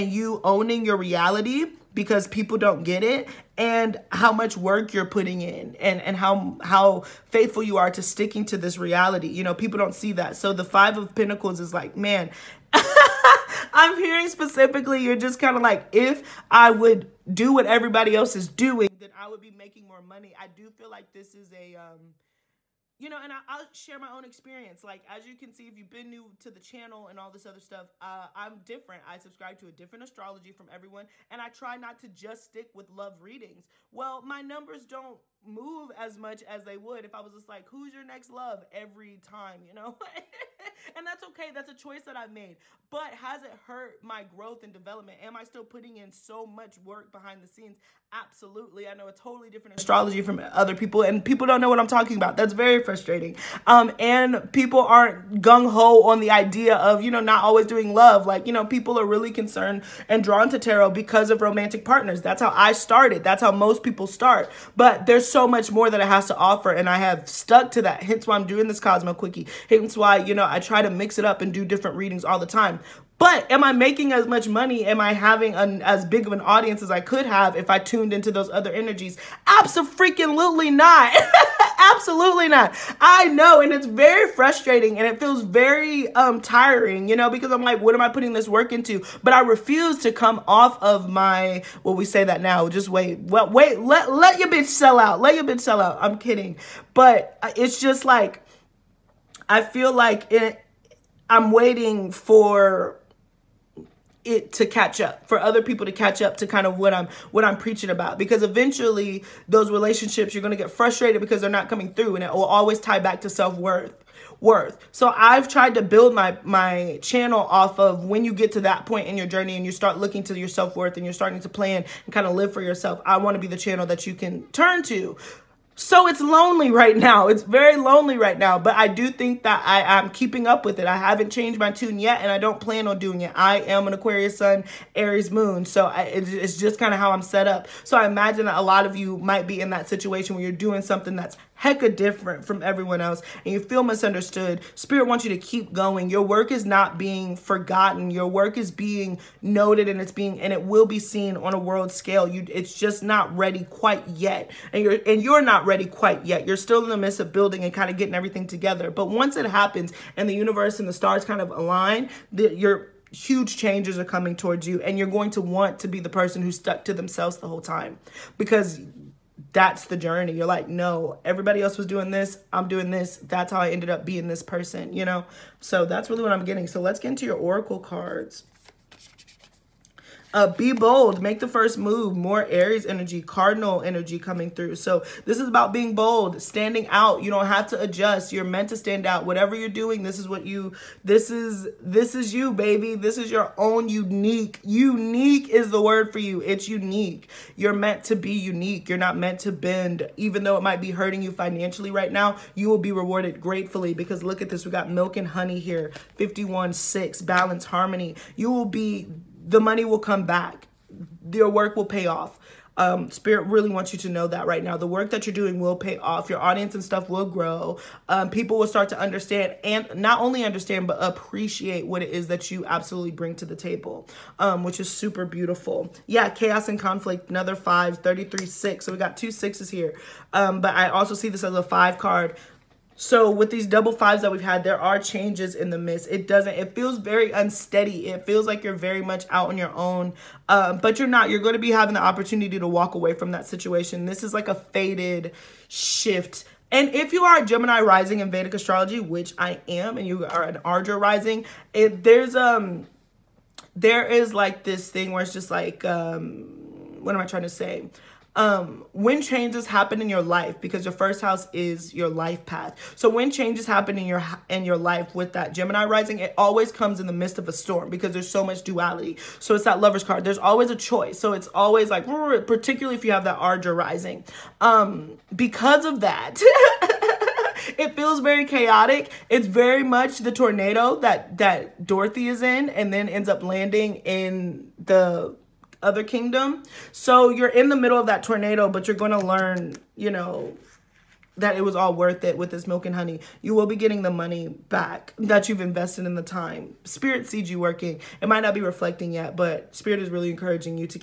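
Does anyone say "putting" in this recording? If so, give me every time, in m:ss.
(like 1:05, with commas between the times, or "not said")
0:05, 0:45, 1:28.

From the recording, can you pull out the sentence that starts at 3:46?
Yeah, chaos and conflict, another five, 33, six.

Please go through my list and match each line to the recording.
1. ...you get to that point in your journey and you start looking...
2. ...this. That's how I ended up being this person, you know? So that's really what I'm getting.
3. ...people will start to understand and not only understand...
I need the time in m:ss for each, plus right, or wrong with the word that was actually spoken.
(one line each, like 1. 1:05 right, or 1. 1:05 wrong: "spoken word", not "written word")
1. 1:58 right
2. 2:52 right
3. 3:38 right.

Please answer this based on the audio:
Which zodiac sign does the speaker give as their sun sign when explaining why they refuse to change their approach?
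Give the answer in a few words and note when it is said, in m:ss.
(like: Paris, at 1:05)
Aquarius, at 2:13.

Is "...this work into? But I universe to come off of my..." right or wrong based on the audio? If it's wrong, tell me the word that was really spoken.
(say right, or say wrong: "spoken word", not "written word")
wrong: "refuse", not "universe".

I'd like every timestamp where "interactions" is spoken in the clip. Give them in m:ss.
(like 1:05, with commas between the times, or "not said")
not said.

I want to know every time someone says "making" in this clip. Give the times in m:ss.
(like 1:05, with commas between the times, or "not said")
0:19, 1:13.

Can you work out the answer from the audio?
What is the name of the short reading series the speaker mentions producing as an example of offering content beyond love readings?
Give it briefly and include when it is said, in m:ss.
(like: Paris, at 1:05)
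Kosmo Quickie, at 1:08.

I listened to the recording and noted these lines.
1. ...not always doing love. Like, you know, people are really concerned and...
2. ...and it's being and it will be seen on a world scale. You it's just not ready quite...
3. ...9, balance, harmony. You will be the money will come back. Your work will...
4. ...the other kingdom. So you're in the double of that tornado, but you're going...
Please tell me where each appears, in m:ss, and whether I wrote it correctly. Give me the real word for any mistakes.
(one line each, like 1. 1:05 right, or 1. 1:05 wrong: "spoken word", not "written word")
1. 0:57 right
2. 2:29 right
3. 3:26 wrong: "6", not "9"
4. 4:44 wrong: "middle", not "double".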